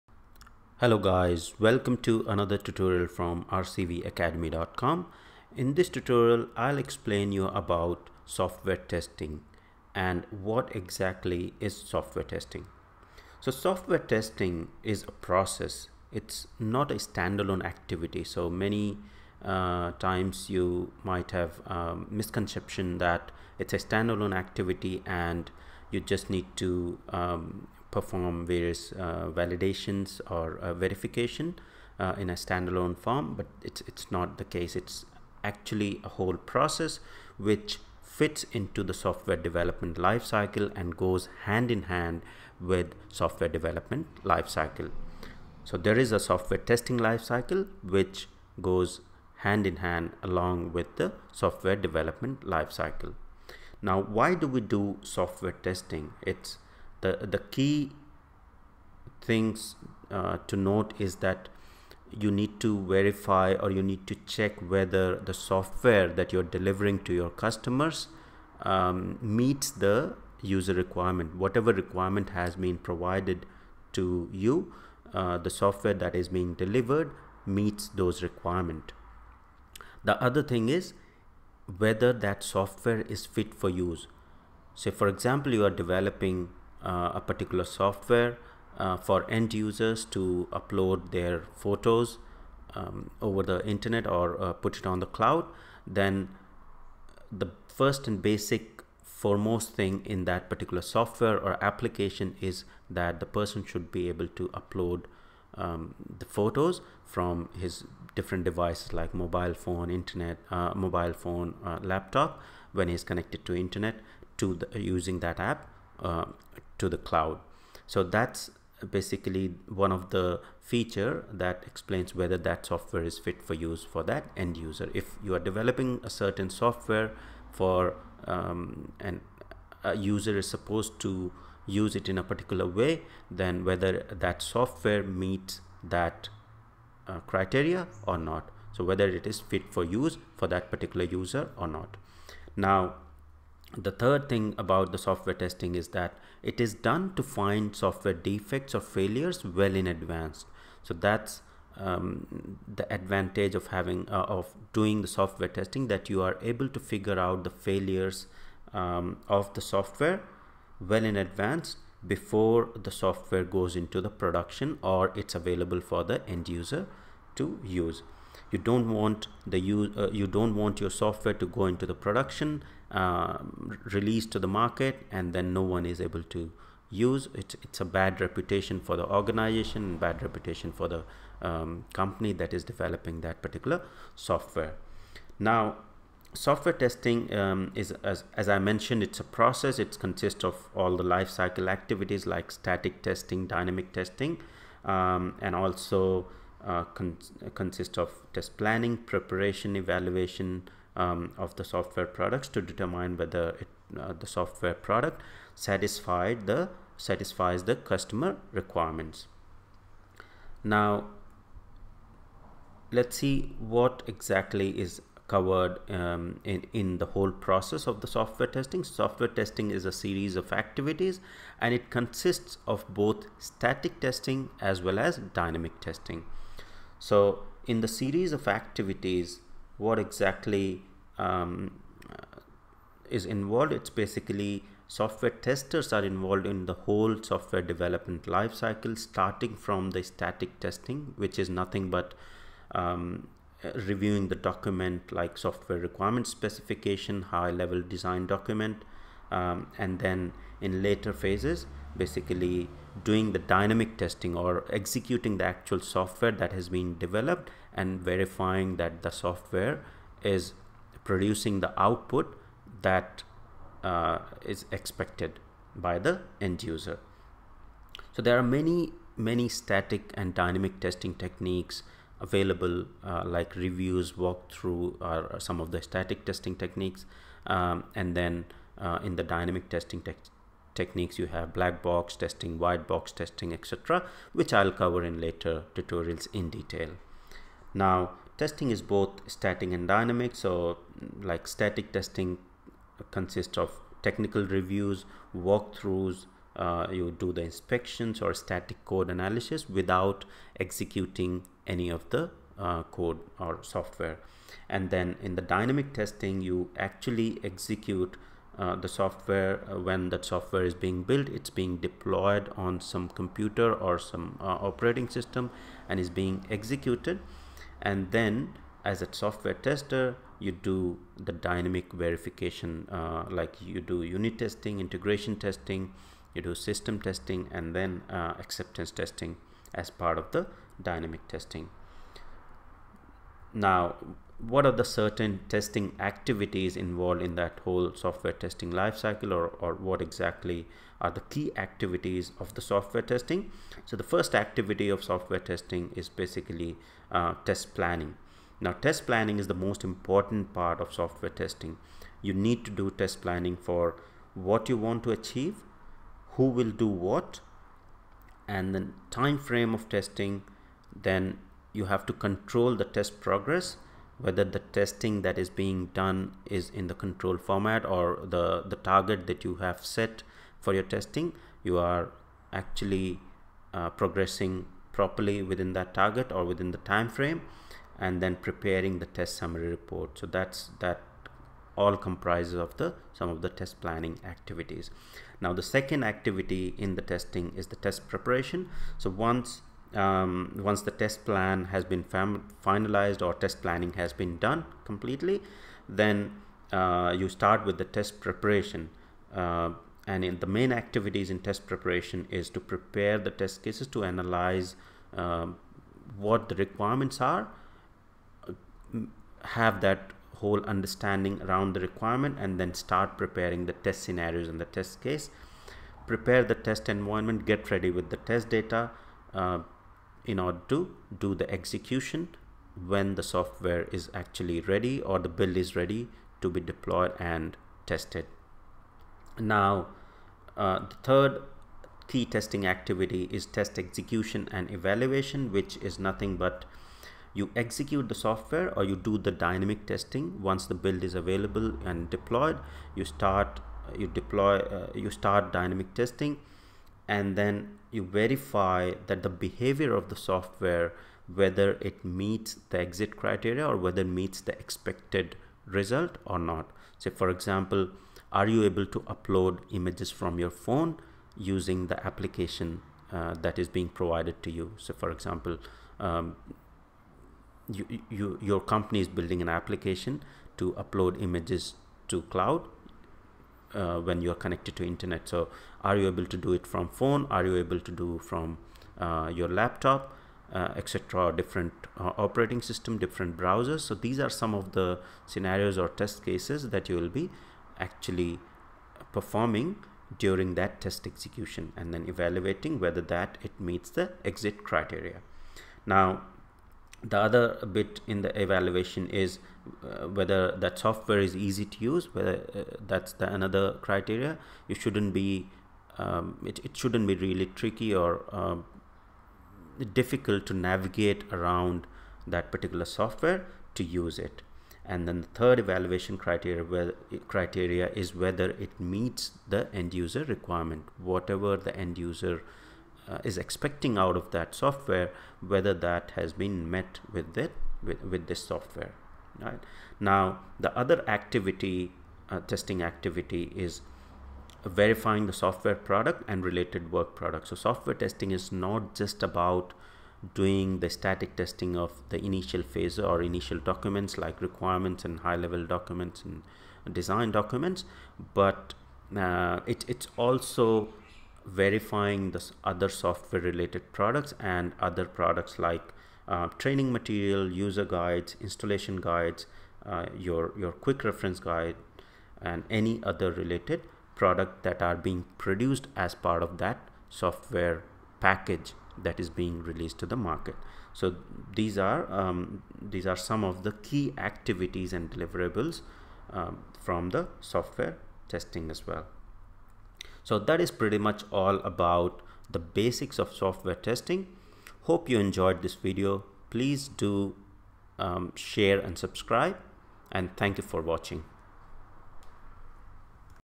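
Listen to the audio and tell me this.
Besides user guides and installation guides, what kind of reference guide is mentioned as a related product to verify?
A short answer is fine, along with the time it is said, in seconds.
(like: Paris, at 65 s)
quick reference guide, at 560 s.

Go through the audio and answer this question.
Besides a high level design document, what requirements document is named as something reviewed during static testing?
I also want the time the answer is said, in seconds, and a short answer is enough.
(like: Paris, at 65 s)
software requirement specification, at 245 s.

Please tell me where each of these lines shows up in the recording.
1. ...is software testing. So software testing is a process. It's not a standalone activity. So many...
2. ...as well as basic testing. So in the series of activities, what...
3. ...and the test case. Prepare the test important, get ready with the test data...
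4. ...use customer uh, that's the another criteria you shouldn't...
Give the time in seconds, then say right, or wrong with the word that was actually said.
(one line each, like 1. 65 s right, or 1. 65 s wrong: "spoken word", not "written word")
1. 11 s right
2. 224 s wrong: "dynamic", not "basic"
3. 414 s wrong: "environment", not "important"
4. 501 s wrong: "whether", not "customer".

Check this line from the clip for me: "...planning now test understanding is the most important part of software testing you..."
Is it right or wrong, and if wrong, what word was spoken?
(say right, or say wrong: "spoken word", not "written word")
wrong: "planning", not "understanding".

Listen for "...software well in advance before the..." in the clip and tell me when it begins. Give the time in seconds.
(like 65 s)
159 s.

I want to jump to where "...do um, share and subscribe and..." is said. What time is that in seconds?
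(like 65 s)
586 s.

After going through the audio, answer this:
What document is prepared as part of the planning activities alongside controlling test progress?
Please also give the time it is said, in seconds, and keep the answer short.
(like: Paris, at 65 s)
test summary report, at 379 s.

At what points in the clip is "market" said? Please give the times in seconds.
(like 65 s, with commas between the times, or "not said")
174 s, 570 s.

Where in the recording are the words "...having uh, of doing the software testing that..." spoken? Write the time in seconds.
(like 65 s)
153 s.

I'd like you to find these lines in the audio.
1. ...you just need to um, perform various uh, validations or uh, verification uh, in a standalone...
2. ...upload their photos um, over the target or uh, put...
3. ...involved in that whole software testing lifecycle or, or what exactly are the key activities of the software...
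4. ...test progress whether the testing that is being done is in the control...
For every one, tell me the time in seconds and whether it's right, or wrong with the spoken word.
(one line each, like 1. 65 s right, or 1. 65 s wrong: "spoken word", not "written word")
1. 25 s right
2. 90 s wrong: "internet", not "target"
3. 336 s right
4. 362 s right.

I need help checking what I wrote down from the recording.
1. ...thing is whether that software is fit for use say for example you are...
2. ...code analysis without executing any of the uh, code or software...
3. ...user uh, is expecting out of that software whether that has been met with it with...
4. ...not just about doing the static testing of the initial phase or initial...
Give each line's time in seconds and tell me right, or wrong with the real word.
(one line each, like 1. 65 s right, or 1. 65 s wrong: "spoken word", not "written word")
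1. 80 s right
2. 298 s right
3. 521 s right
4. 538 s right.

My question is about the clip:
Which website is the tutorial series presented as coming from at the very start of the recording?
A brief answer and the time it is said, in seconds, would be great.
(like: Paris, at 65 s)
rcvacademy.com, at 3 s.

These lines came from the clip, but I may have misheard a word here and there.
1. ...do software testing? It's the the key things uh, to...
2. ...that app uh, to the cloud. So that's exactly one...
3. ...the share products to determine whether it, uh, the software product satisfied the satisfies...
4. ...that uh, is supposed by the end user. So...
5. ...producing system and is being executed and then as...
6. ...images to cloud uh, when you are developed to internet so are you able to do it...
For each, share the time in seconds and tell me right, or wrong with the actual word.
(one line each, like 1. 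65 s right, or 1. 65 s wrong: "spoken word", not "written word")
1. 54 s right
2. 115 s wrong: "basically", not "exactly"
3. 201 s wrong: "software", not "share"
4. 262 s wrong: "expected", not "supposed"
5. 314 s wrong: "operating", not "producing"
6. 471 s wrong: "connected", not "developed".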